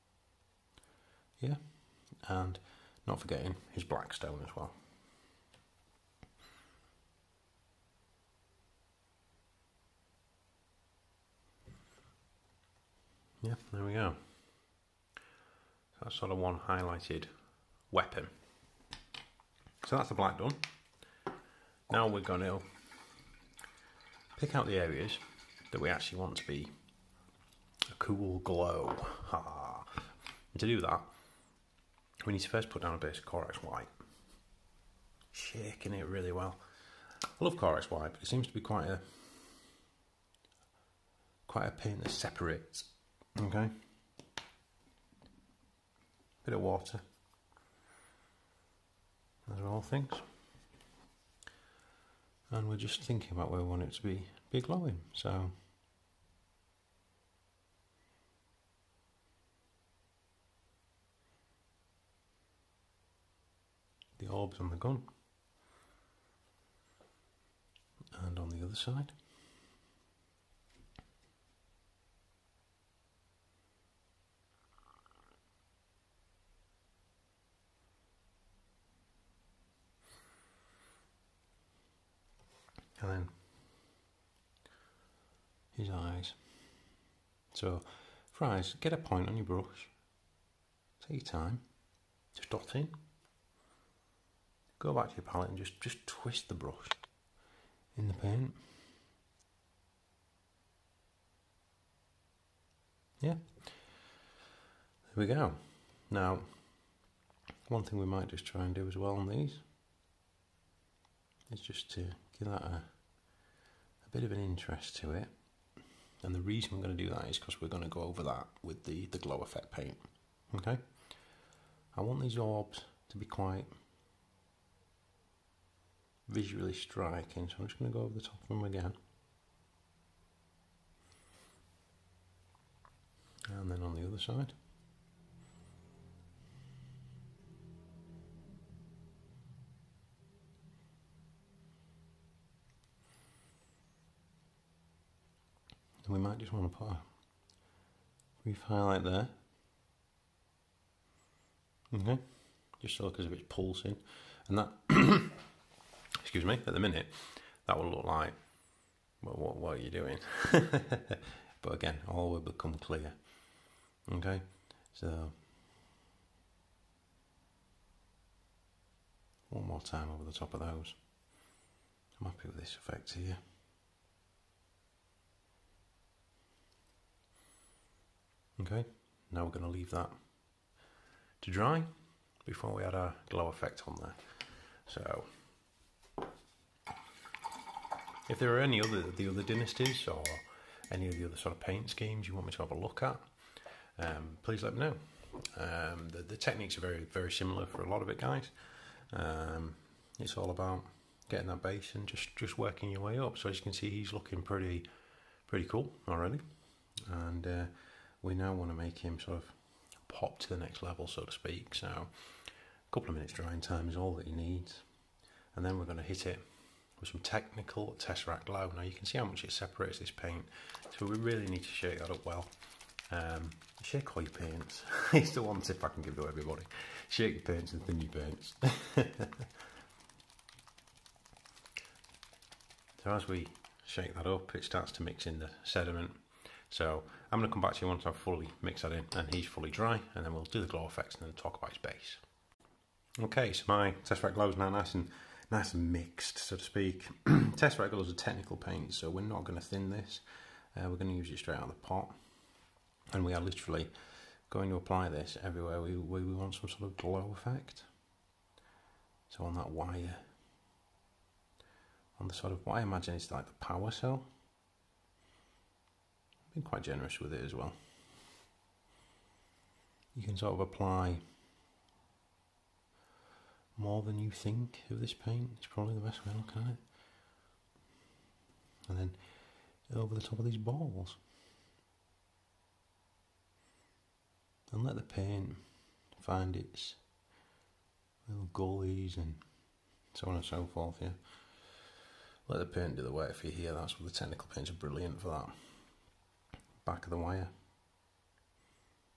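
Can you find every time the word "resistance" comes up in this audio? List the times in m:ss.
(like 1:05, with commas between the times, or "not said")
not said.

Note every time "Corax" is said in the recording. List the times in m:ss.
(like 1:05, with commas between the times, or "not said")
0:33, 0:37.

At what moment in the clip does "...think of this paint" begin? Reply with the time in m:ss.
4:34.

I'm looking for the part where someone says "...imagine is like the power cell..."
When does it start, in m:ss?
4:22.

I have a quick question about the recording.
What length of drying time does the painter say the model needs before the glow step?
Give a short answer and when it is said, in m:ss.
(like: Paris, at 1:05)
A couple of minutes, at 3:31.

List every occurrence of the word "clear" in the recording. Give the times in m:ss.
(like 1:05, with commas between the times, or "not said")
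2:42.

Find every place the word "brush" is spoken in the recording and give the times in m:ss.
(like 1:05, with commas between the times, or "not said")
1:29, 1:36.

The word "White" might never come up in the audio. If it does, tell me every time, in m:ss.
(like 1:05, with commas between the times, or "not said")
0:33, 0:37.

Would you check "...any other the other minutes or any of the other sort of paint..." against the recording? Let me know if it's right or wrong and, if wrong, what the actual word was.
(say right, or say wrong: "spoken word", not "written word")
wrong: "dynasties", not "minutes".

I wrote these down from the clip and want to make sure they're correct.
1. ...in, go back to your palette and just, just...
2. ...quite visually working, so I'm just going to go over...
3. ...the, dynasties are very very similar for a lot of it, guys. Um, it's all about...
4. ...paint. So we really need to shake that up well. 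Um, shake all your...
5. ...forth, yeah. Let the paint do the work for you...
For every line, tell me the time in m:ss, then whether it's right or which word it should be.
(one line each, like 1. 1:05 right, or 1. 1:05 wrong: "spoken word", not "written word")
1. 1:32 right
2. 2:03 wrong: "striking", not "working"
3. 3:16 wrong: "techniques", not "dynasties"
4. 3:40 right
5. 4:50 right.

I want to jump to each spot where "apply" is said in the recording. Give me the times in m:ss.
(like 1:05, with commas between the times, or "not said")
4:14, 4:30.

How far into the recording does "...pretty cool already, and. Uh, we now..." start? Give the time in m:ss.
3:25.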